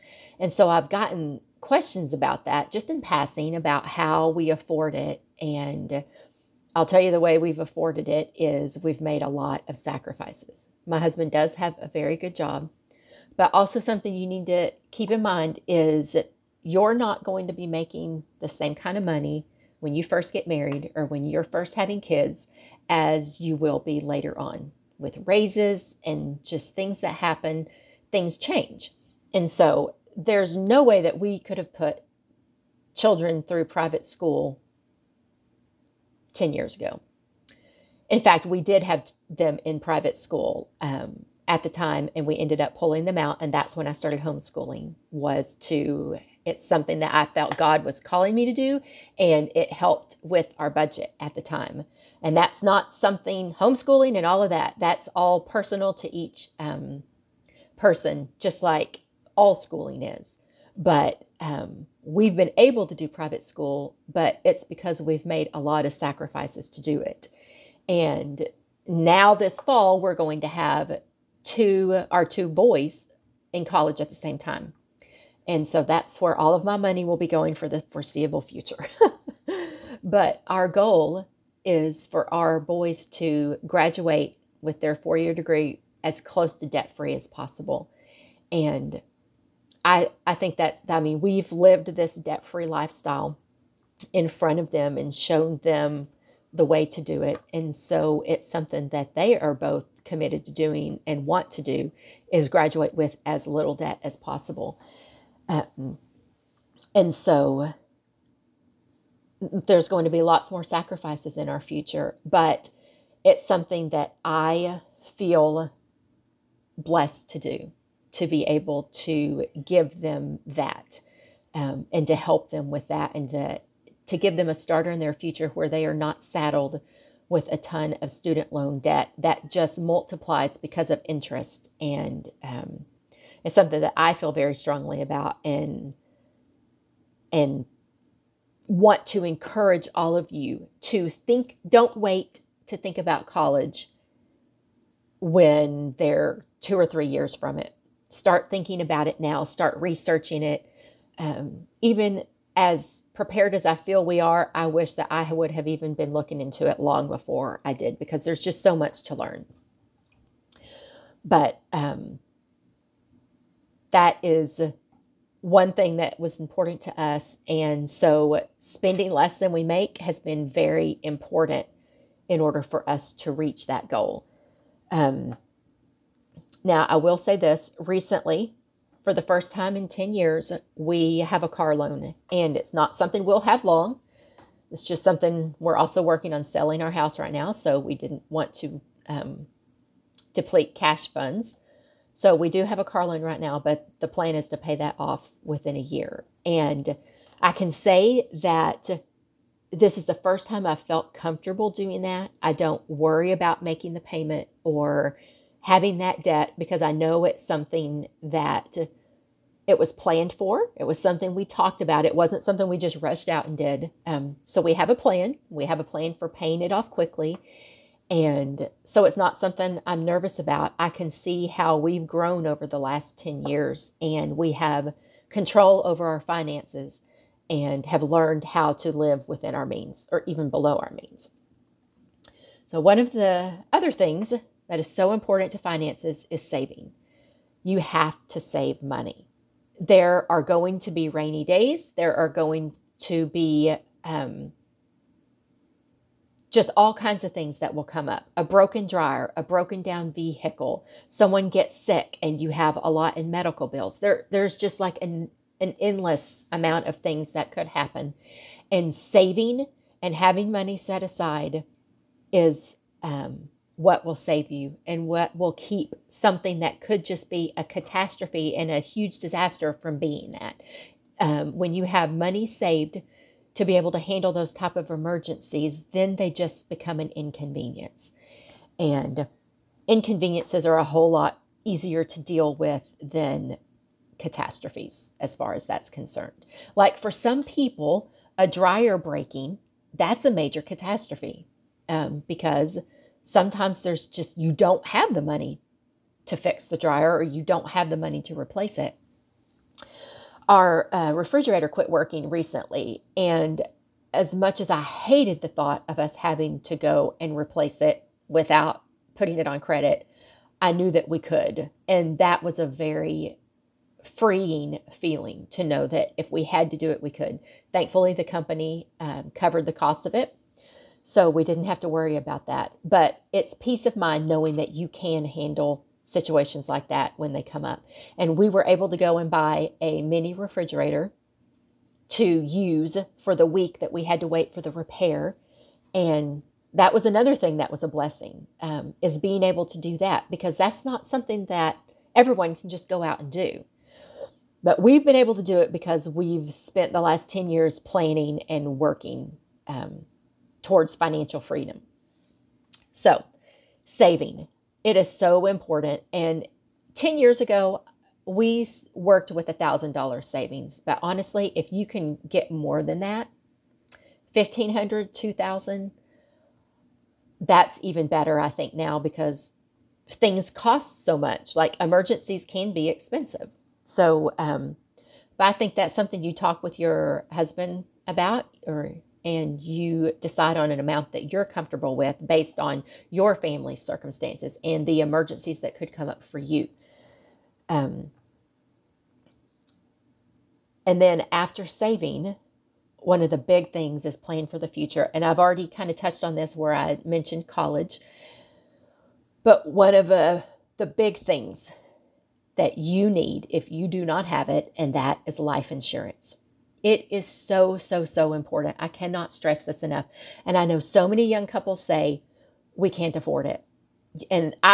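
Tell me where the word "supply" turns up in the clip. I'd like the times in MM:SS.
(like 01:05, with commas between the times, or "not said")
not said.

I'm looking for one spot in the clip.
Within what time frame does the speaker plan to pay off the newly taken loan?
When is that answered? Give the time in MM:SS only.
03:15.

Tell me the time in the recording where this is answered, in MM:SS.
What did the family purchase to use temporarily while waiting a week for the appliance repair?
05:30.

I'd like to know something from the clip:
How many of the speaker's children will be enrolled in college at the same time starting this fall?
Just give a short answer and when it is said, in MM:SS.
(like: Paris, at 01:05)
2, at 01:11.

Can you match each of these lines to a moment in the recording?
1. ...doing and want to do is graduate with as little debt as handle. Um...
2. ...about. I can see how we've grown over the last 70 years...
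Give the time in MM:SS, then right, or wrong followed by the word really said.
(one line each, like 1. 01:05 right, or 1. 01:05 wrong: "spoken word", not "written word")
1. 01:40 wrong: "possible", not "handle"
2. 03:40 wrong: "10", not "70".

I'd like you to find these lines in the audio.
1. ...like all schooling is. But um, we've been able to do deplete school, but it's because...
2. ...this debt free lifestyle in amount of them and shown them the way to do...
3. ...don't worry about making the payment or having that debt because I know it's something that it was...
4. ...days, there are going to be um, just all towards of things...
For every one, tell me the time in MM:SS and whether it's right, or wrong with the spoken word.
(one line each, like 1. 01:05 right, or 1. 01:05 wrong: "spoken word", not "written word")
1. 00:58 wrong: "private", not "deplete"
2. 01:31 wrong: "front", not "amount"
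3. 03:22 right
4. 04:01 wrong: "kinds", not "towards".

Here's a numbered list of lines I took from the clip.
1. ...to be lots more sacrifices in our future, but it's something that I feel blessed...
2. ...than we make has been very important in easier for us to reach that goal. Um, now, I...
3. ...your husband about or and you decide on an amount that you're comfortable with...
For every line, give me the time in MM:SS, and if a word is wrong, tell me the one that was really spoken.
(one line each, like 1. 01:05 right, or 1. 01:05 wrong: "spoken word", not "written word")
1. 01:50 right
2. 02:49 wrong: "order", not "easier"
3. 06:16 right.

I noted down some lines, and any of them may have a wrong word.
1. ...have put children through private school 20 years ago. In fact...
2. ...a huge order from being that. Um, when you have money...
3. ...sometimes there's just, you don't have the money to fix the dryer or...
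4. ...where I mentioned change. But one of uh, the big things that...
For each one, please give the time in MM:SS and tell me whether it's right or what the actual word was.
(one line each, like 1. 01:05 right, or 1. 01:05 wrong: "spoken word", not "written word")
1. 00:31 wrong: "10", not "20"
2. 04:28 wrong: "disaster", not "order"
3. 04:53 right
4. 06:36 wrong: "college", not "change".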